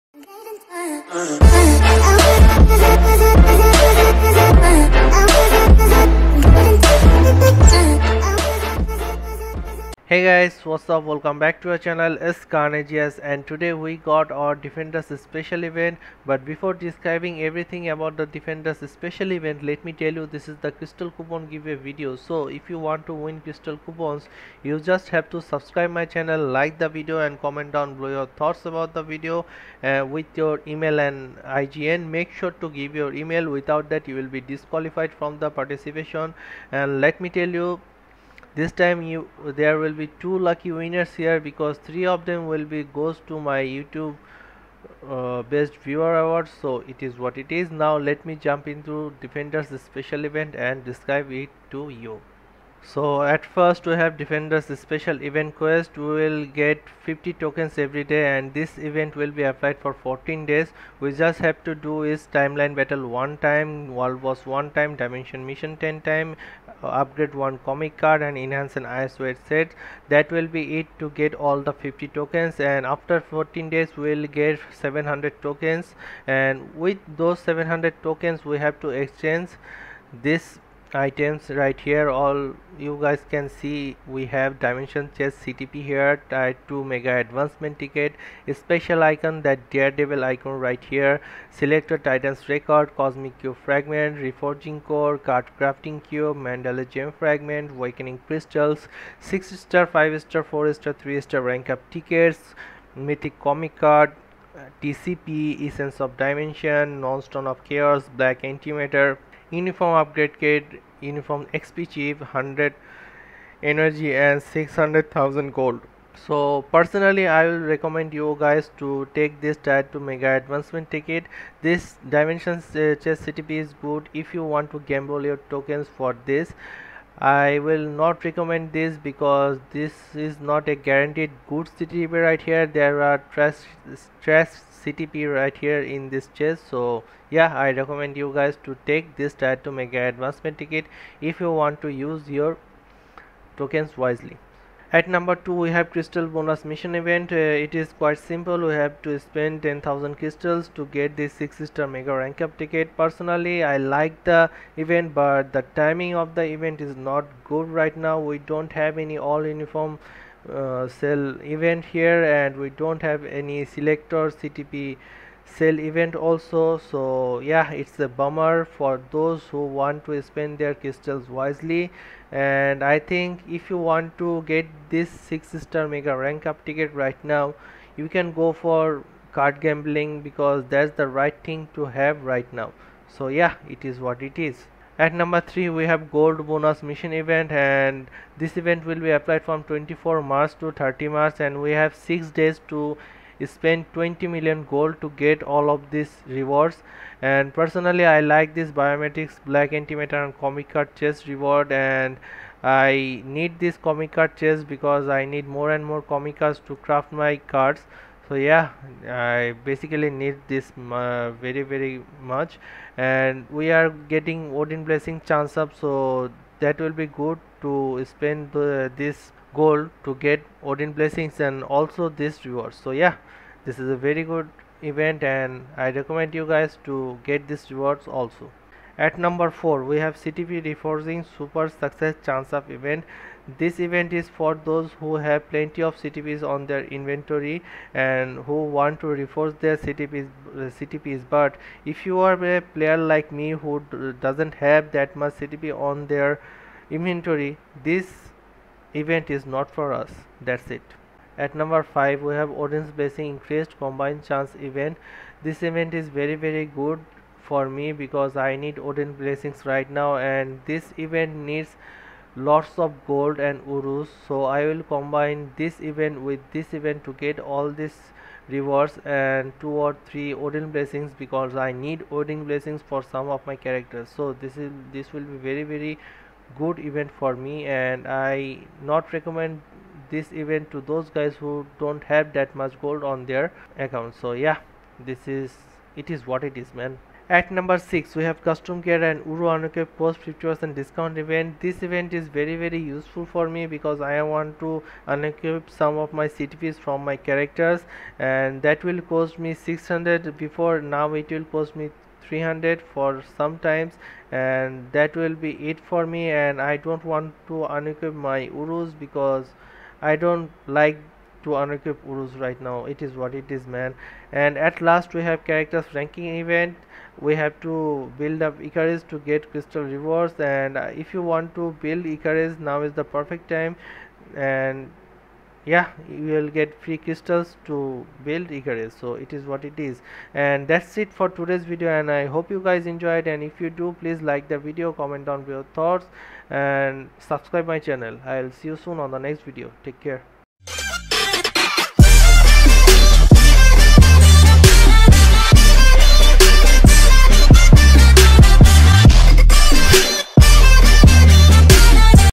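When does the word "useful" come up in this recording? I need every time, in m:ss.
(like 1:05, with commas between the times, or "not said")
4:52.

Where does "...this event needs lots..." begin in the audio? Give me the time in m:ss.
4:20.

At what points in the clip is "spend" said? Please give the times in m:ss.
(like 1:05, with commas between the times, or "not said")
2:29, 2:50, 3:13, 3:38.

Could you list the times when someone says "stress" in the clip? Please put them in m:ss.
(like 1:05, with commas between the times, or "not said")
2:13.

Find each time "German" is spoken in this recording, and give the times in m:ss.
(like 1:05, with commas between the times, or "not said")
not said.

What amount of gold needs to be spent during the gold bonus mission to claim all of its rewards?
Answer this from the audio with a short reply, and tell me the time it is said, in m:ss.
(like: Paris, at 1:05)
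20 million, at 3:13.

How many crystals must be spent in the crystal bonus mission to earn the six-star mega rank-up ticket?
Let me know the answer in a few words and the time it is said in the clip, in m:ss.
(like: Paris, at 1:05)
10,000, at 2:29.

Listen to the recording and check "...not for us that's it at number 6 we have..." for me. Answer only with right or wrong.
wrong.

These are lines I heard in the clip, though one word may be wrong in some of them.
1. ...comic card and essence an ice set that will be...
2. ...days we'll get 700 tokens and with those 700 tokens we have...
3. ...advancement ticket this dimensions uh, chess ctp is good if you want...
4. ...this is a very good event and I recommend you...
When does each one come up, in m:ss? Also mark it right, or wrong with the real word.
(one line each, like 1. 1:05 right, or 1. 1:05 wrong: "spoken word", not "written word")
1. 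1:07 wrong: "enhance", not "essence"
2. 1:13 right
3. 2:00 right
4. 3:43 right.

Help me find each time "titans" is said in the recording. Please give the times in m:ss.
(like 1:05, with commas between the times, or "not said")
1:31.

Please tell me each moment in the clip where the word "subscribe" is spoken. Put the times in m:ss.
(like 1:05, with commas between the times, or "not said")
0:25, 5:37.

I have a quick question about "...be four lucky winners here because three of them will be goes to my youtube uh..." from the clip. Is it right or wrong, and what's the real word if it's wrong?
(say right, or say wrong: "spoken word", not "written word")
wrong: "two", not "four".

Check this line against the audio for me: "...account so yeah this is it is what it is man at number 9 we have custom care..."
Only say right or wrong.
wrong.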